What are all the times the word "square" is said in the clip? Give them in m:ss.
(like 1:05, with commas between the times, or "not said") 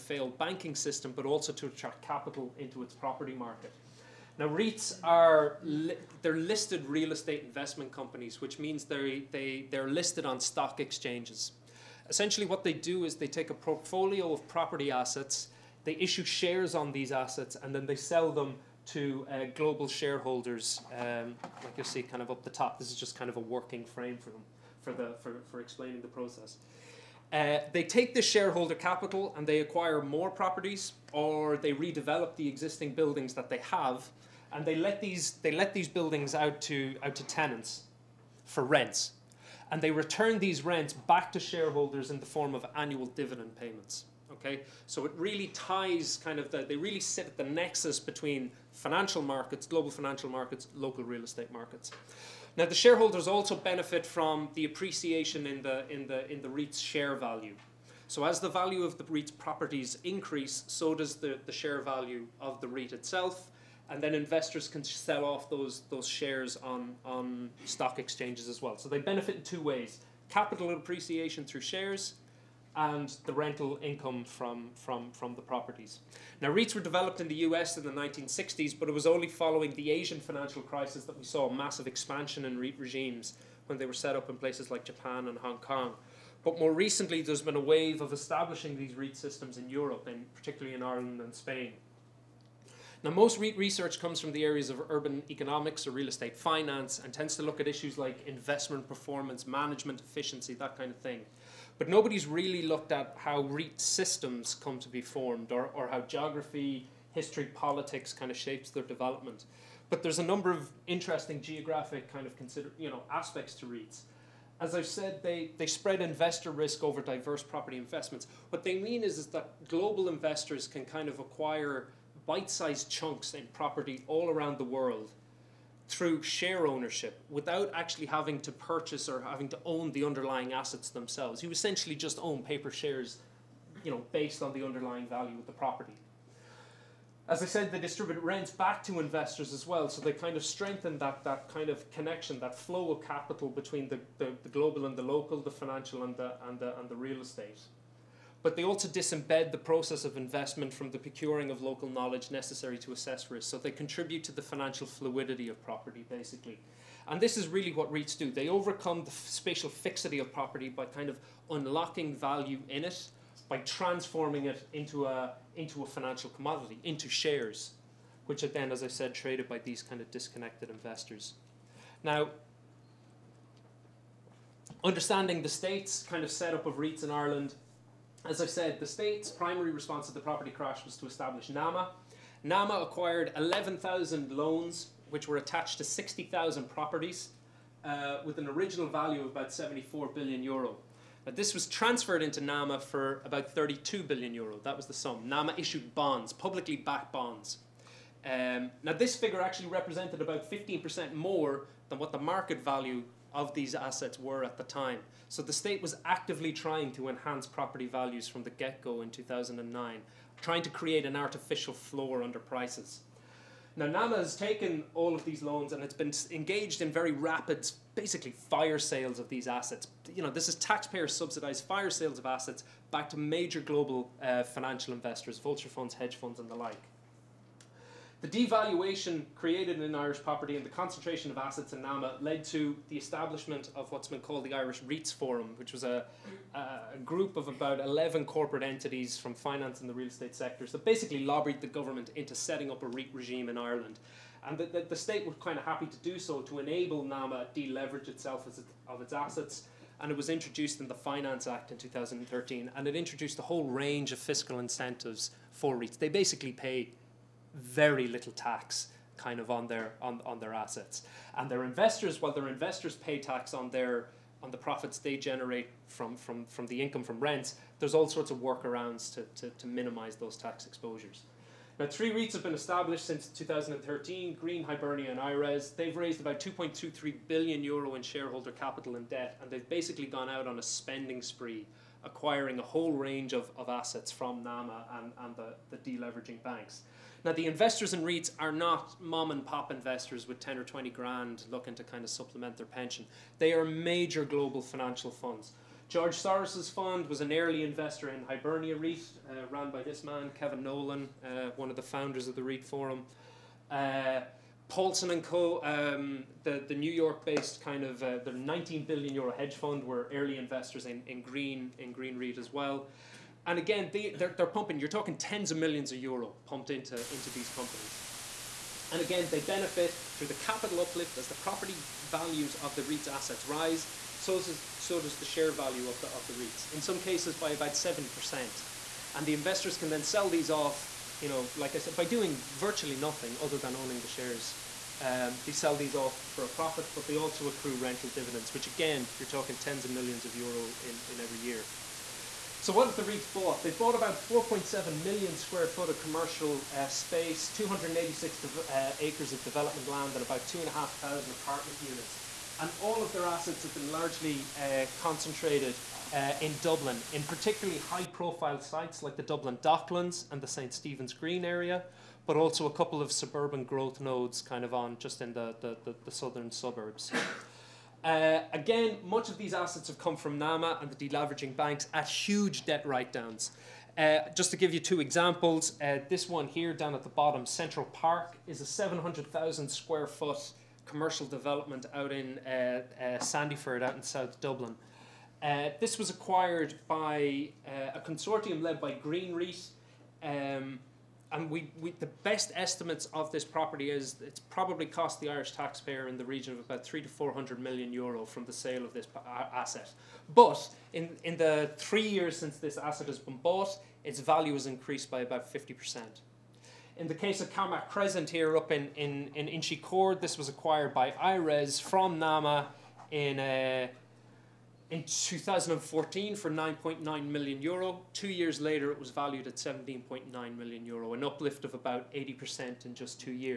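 5:45, 6:19.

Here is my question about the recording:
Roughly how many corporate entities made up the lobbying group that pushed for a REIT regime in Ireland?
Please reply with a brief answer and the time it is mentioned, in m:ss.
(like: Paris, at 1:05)
11, at 3:57.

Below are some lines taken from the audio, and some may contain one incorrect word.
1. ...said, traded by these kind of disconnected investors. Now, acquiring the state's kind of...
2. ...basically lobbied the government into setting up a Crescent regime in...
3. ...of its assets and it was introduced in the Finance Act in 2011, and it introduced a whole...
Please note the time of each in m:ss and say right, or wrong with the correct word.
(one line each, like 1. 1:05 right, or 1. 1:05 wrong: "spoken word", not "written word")
1. 2:48 wrong: "understanding", not "acquiring"
2. 4:00 wrong: "REIT", not "Crescent"
3. 4:08 wrong: "2013", not "2011".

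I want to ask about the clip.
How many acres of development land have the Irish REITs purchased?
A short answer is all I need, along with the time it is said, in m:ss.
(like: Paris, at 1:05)
286, at 5:47.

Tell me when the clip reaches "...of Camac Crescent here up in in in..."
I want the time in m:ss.
6:47.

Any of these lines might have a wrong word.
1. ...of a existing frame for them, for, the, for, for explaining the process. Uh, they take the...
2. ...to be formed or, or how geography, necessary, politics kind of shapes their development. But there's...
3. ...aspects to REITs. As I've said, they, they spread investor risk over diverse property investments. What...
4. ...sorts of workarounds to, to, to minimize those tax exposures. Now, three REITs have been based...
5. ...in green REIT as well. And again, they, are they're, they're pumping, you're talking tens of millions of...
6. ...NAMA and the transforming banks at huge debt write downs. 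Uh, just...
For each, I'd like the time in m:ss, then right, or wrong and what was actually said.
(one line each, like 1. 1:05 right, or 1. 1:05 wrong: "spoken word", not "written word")
1. 0:23 wrong: "working", not "existing"
2. 1:44 wrong: "history", not "necessary"
3. 1:53 right
4. 4:28 wrong: "established", not "based"
5. 5:11 right
6. 6:10 wrong: "deleveraging", not "transforming".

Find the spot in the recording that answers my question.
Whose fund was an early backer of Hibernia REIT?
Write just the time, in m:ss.
4:55.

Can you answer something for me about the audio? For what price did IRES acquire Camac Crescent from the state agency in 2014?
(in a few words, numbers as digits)
9.9 million euro.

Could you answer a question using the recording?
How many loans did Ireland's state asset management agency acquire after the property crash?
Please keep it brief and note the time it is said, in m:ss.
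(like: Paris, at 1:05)
11,000, at 3:03.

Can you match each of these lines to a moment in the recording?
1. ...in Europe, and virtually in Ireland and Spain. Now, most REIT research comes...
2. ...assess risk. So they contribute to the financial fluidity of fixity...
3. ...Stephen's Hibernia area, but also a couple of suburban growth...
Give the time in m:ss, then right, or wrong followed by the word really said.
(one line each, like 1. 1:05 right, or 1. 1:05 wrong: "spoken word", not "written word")
1. 1:29 wrong: "particularly", not "virtually"
2. 2:32 wrong: "property", not "fixity"
3. 6:00 wrong: "Green", not "Hibernia".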